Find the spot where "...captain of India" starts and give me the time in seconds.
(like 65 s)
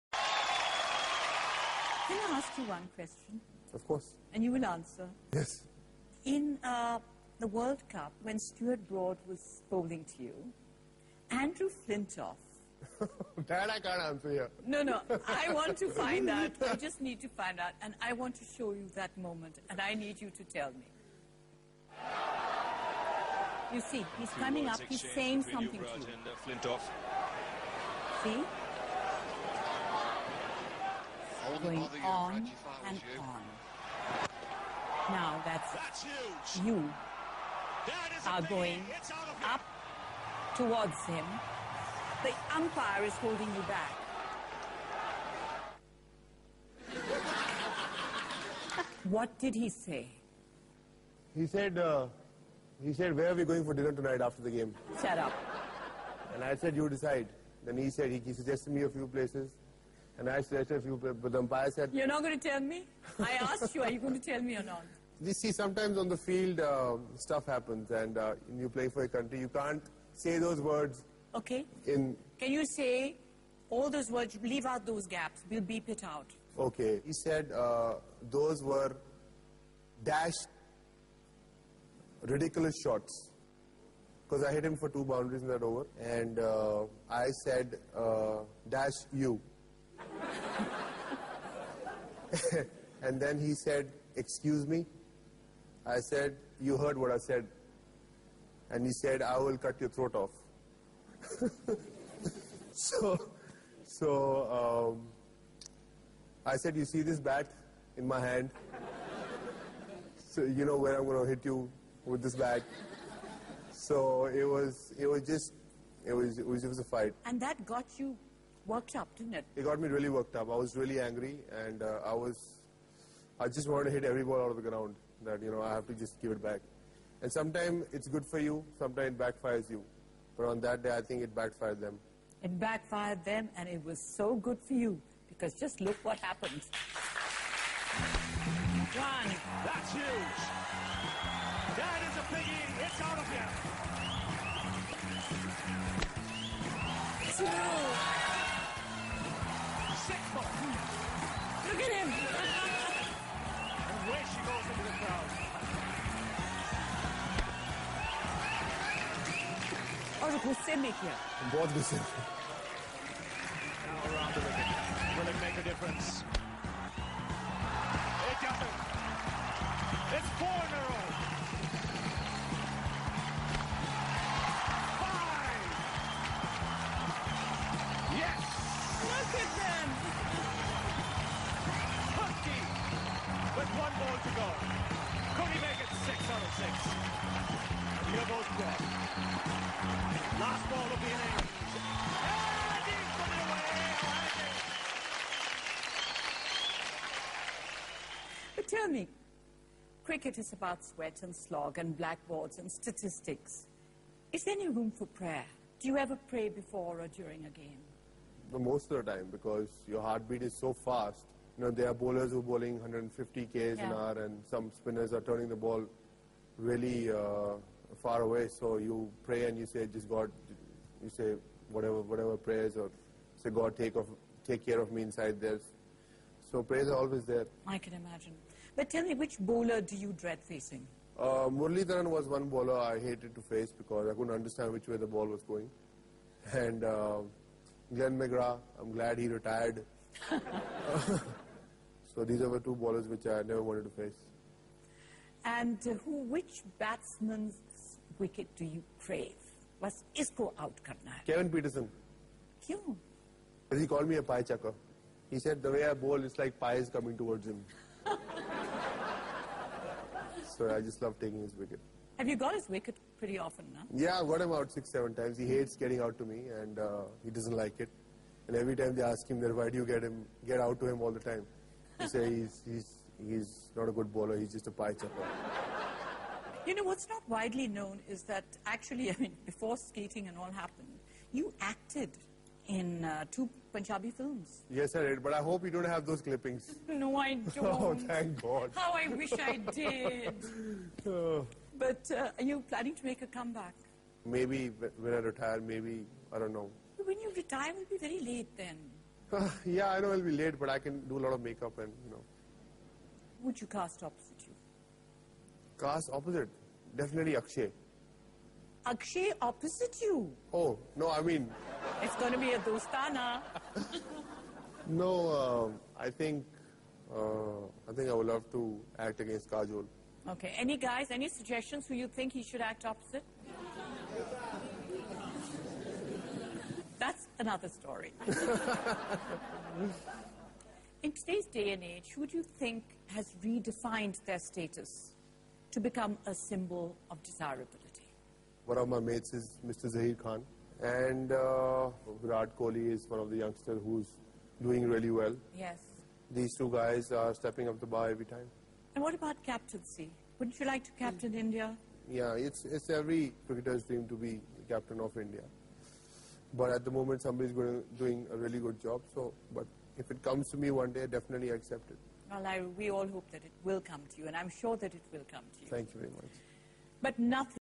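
354 s.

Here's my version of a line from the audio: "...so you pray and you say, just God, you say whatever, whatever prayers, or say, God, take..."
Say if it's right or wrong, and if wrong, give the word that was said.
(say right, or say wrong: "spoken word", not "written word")
right.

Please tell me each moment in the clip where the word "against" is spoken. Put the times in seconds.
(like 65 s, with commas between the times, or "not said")
319 s.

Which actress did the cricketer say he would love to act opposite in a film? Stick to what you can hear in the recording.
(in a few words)
Kajol.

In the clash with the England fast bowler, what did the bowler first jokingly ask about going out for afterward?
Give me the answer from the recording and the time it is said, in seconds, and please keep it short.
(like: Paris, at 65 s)
Dinner, at 53 s.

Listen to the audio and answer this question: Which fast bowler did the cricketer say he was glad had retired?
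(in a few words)
Glenn McGrath.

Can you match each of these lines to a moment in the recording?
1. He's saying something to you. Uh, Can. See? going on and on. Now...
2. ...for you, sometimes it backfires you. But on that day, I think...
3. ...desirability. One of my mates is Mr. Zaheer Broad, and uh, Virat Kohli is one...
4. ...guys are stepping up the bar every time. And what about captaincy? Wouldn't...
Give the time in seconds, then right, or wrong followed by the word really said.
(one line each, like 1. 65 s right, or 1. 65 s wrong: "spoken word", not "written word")
1. 24 s wrong: "Flintoff", not "Can"
2. 128 s right
3. 337 s wrong: "Khan", not "Broad"
4. 346 s right.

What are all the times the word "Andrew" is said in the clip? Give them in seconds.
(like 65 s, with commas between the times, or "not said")
11 s.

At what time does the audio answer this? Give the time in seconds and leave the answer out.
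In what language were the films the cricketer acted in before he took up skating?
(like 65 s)
283 s.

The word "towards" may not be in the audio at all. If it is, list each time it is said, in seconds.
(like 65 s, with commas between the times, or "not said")
40 s, 257 s.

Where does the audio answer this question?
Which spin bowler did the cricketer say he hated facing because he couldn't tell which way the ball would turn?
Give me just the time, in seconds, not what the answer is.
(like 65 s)
231 s.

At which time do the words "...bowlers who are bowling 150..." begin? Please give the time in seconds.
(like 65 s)
211 s.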